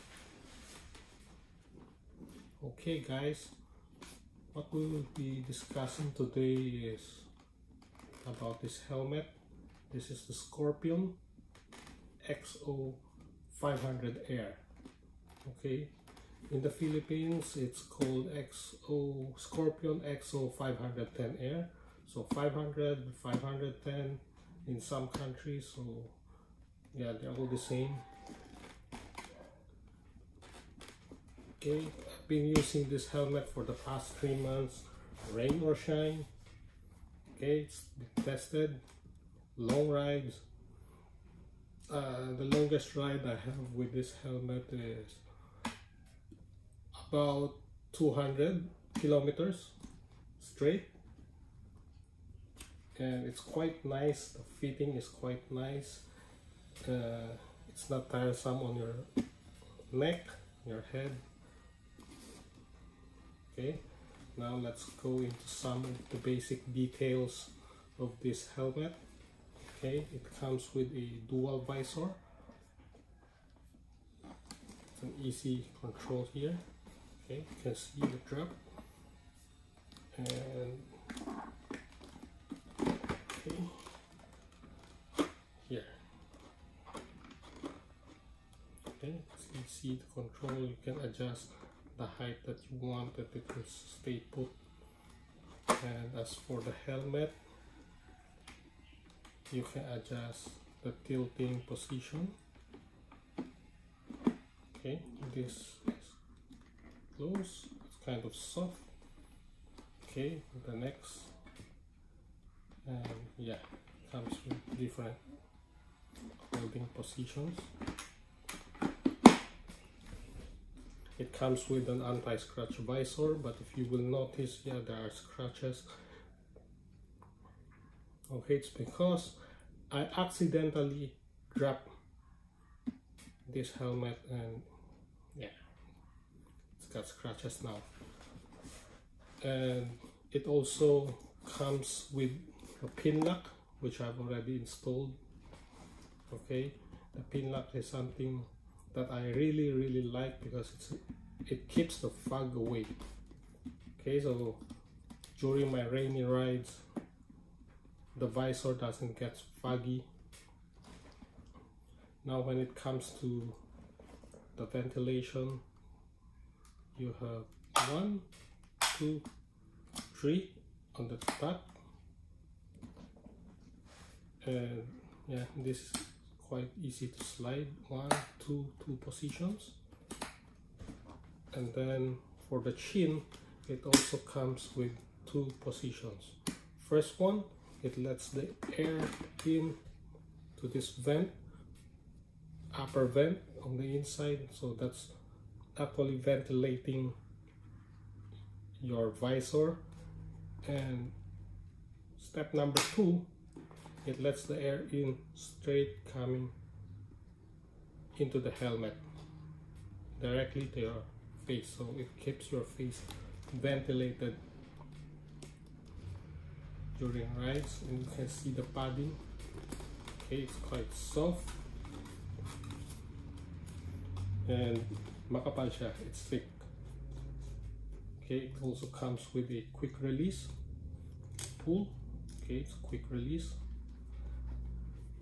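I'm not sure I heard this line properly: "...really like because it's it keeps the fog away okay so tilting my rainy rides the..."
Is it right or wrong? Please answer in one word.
wrong.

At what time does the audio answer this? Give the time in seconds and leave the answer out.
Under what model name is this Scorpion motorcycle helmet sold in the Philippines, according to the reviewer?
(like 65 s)
18 s.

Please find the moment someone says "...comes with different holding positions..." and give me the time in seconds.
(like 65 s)
114 s.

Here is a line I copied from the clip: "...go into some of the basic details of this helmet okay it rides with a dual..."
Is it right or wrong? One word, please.
wrong.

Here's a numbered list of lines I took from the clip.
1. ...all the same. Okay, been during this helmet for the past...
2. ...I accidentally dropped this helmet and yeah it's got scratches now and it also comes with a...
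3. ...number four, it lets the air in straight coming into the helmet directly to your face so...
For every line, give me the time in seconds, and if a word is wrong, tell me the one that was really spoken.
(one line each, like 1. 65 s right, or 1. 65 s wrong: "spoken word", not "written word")
1. 27 s wrong: "using", not "during"
2. 129 s right
3. 202 s wrong: "two", not "four".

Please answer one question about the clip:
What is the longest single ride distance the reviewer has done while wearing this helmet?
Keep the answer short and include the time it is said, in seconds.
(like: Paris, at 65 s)
200 kilometers, at 47 s.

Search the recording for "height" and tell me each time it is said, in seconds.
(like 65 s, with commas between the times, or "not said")
92 s.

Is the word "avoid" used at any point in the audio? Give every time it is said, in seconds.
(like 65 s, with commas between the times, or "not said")
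not said.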